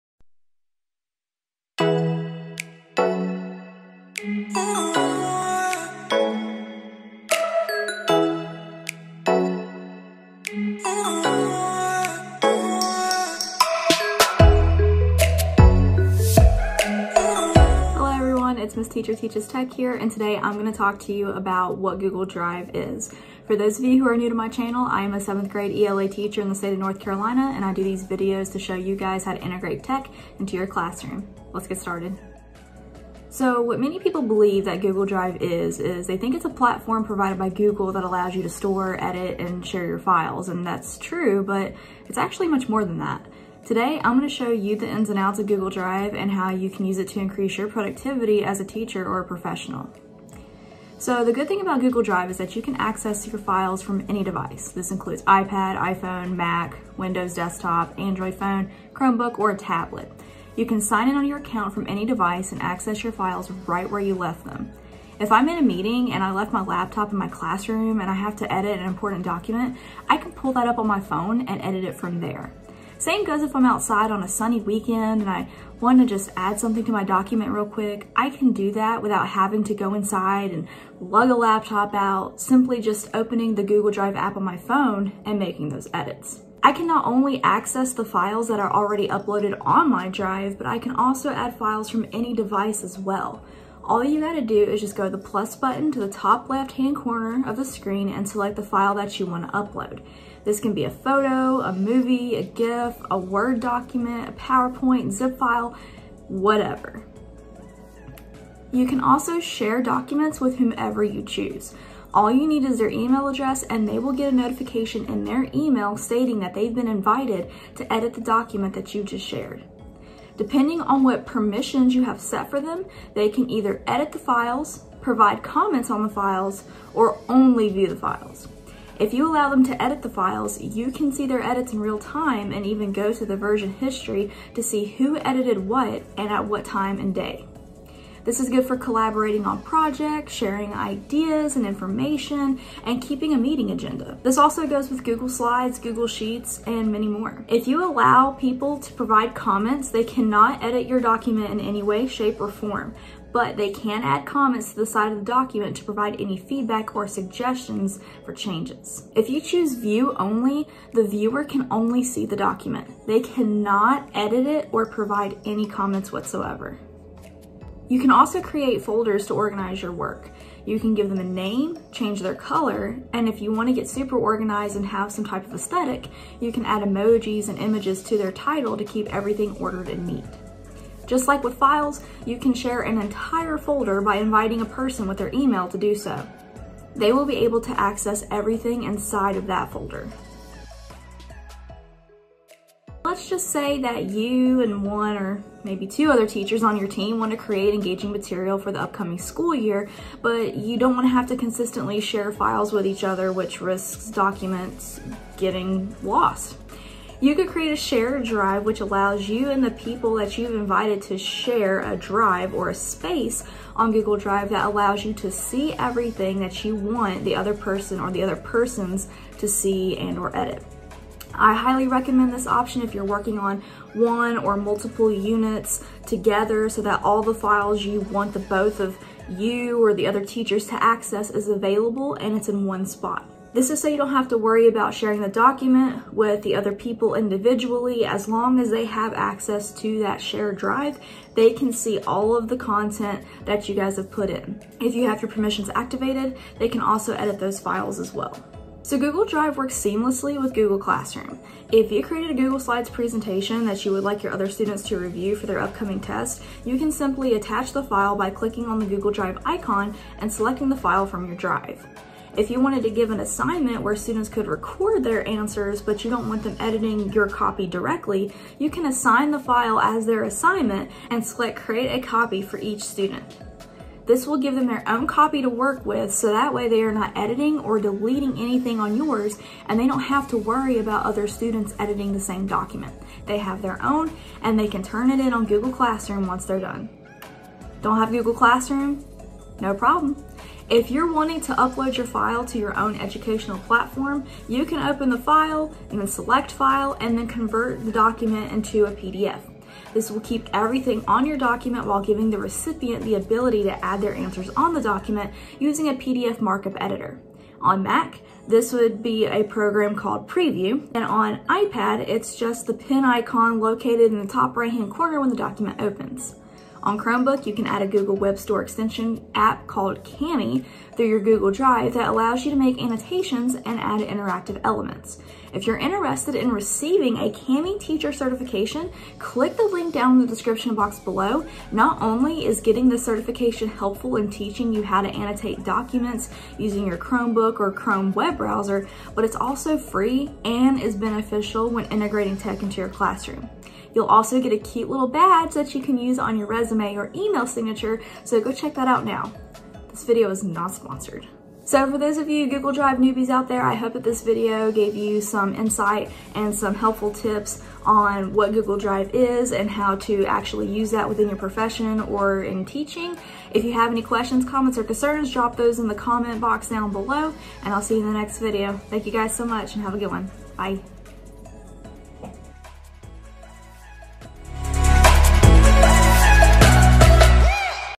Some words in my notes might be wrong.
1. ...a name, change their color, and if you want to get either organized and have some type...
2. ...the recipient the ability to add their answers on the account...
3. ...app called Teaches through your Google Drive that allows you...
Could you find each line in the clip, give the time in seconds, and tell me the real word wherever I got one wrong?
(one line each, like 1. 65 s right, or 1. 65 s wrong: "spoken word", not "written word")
1. 171 s wrong: "super", not "either"
2. 302 s wrong: "document", not "account"
3. 319 s wrong: "Kami", not "Teaches".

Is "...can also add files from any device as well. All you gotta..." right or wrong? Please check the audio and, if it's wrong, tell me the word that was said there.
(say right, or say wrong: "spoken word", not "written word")
right.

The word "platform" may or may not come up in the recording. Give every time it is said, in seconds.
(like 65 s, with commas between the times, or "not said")
36 s, 293 s.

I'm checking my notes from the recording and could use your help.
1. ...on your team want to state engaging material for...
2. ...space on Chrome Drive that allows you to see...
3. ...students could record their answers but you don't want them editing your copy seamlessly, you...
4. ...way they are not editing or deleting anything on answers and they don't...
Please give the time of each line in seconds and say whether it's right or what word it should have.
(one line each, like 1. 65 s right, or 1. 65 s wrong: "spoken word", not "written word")
1. 196 s wrong: "create", not "state"
2. 212 s wrong: "Google", not "Chrome"
3. 263 s wrong: "directly", not "seamlessly"
4. 276 s wrong: "yours", not "answers".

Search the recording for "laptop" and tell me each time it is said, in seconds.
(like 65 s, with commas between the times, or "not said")
66 s, 81 s.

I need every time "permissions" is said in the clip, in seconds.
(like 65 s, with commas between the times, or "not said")
121 s, 245 s.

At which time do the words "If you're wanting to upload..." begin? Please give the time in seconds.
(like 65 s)
290 s.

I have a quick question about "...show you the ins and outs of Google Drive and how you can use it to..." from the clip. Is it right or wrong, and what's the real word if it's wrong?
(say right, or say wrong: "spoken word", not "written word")
right.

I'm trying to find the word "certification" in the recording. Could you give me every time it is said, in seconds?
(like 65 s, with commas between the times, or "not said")
328 s, 332 s.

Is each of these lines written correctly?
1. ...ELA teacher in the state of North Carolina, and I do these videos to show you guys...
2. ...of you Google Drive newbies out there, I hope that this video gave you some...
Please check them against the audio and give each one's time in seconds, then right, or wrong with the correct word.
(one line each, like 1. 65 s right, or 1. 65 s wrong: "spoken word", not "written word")
1. 25 s right
2. 352 s right.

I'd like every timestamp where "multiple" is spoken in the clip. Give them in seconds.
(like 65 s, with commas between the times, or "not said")
224 s.